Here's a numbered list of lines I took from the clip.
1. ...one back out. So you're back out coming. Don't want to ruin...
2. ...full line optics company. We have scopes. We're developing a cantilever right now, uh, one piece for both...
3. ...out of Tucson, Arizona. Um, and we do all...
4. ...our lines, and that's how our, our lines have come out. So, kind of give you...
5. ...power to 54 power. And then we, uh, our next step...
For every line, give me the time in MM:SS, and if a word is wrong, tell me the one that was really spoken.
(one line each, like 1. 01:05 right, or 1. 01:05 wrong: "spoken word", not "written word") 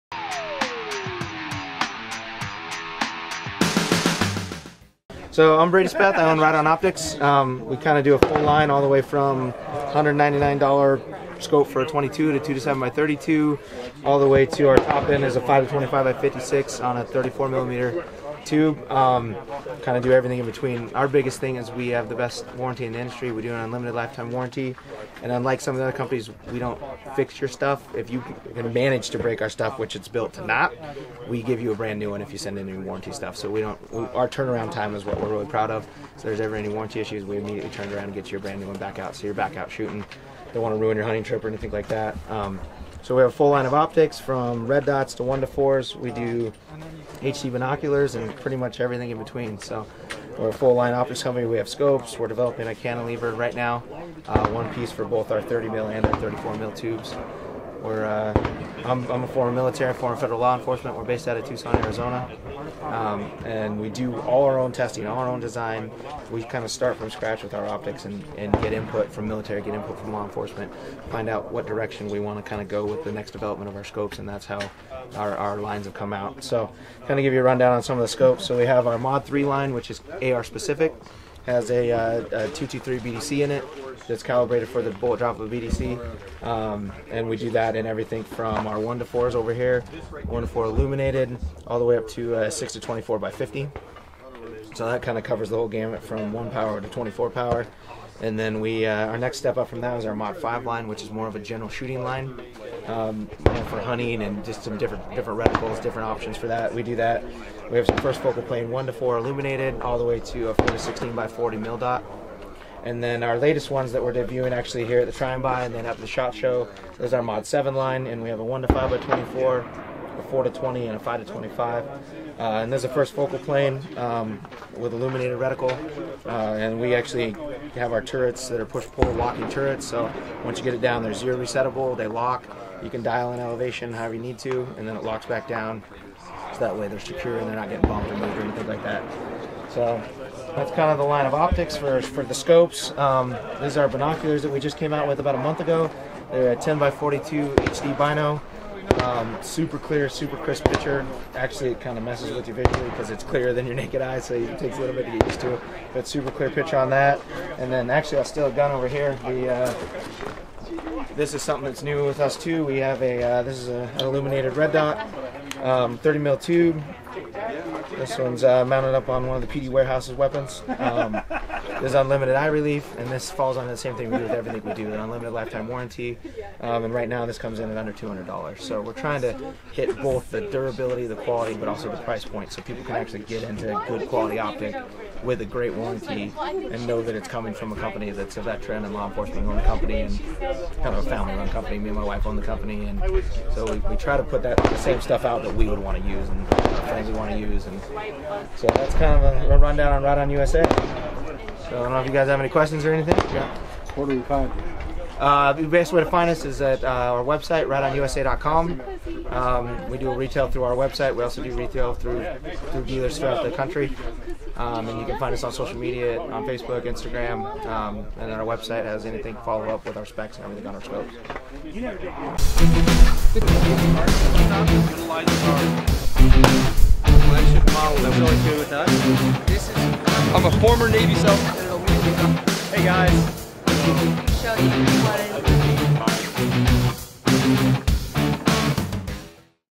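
1. 00:38 wrong: "shooting", not "coming"
2. 00:50 right
3. 01:01 right
4. 01:13 wrong: "scopes", not "lines"
5. 01:36 wrong: "24", not "54".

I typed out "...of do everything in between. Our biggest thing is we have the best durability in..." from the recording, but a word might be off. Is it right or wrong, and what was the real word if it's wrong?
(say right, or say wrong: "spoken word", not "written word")
wrong: "warranty", not "durability".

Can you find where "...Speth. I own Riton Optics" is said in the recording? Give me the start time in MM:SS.
00:05.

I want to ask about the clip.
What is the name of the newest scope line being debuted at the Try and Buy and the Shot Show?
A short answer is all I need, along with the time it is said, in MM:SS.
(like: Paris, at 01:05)
Mod 7, at 01:57.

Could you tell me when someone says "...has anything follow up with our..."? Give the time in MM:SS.
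03:38.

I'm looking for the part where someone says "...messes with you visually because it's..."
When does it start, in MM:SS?
02:32.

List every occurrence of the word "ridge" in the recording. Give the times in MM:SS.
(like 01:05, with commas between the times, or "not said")
not said.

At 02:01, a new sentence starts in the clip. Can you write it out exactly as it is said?
Uh, and there's a first focal plane um, with illuminated reticle.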